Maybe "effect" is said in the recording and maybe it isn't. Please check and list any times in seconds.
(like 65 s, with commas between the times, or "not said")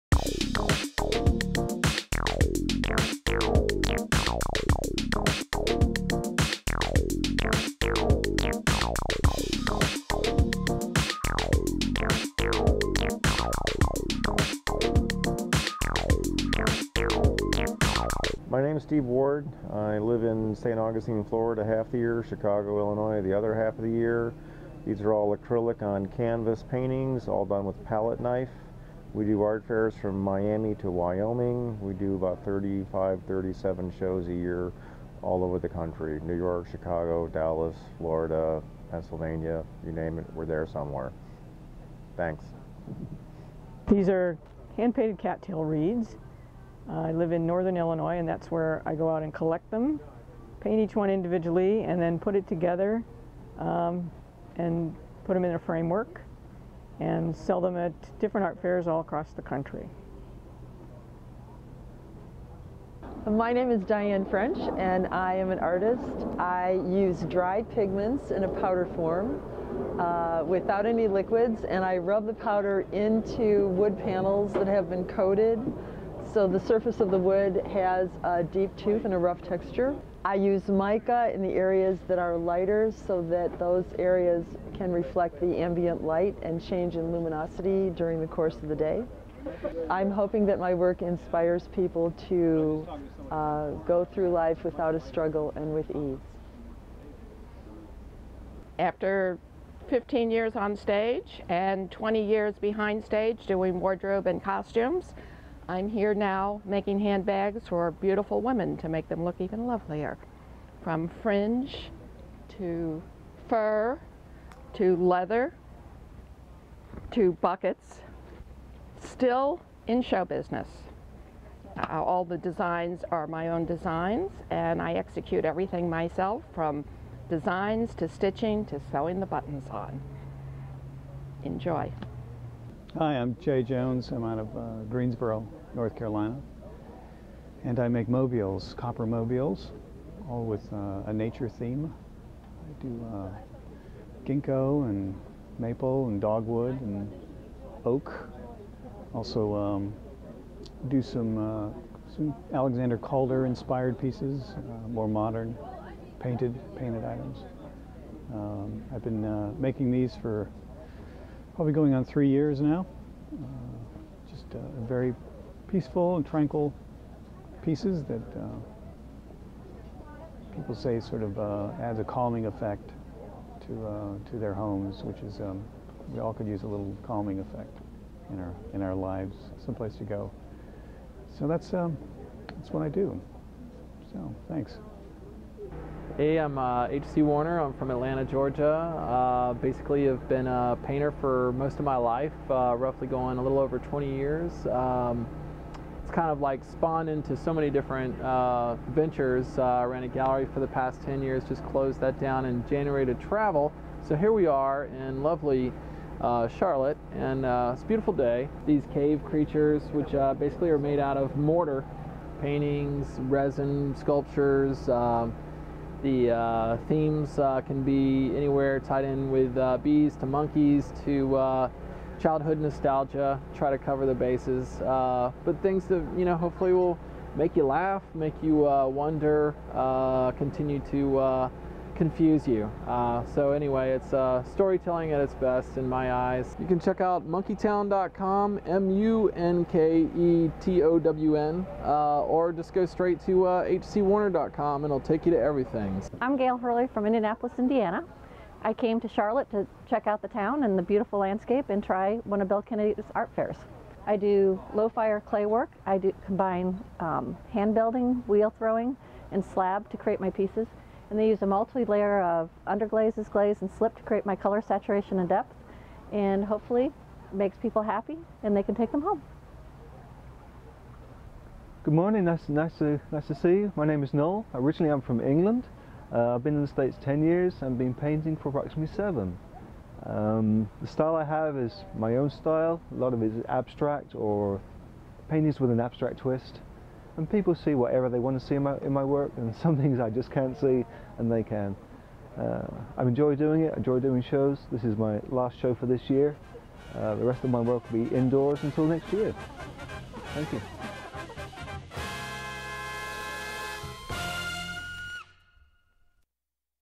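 172 s, 177 s.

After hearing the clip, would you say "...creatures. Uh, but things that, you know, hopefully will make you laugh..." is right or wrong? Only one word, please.
wrong.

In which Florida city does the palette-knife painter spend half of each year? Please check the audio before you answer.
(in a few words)
St. Augustine.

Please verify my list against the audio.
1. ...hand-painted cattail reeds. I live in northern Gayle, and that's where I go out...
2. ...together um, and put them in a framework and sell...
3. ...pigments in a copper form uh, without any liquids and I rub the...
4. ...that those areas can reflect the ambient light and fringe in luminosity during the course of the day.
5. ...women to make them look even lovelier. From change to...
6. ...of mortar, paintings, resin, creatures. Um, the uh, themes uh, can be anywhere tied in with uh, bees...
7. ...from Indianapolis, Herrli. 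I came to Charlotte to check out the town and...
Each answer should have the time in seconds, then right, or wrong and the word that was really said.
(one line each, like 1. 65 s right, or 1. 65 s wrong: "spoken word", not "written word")
1. 44 s wrong: "Illinois", not "Gayle"
2. 52 s right
3. 67 s wrong: "powder", not "copper"
4. 83 s wrong: "change", not "fringe"
5. 108 s wrong: "fringe", not "change"
6. 211 s wrong: "sculptures", not "creatures"
7. 246 s wrong: "Indiana", not "Herrli".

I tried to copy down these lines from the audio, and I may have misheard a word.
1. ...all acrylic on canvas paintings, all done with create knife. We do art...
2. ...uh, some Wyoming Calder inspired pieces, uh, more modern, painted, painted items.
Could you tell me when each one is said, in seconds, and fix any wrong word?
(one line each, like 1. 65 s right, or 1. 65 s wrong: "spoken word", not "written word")
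1. 25 s wrong: "palette", not "create"
2. 151 s wrong: "Alexander", not "Wyoming".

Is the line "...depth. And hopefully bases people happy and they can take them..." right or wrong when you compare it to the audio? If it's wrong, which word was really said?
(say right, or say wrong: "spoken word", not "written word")
wrong: "makes", not "bases".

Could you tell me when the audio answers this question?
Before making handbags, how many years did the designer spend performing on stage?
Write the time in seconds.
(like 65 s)
99 s.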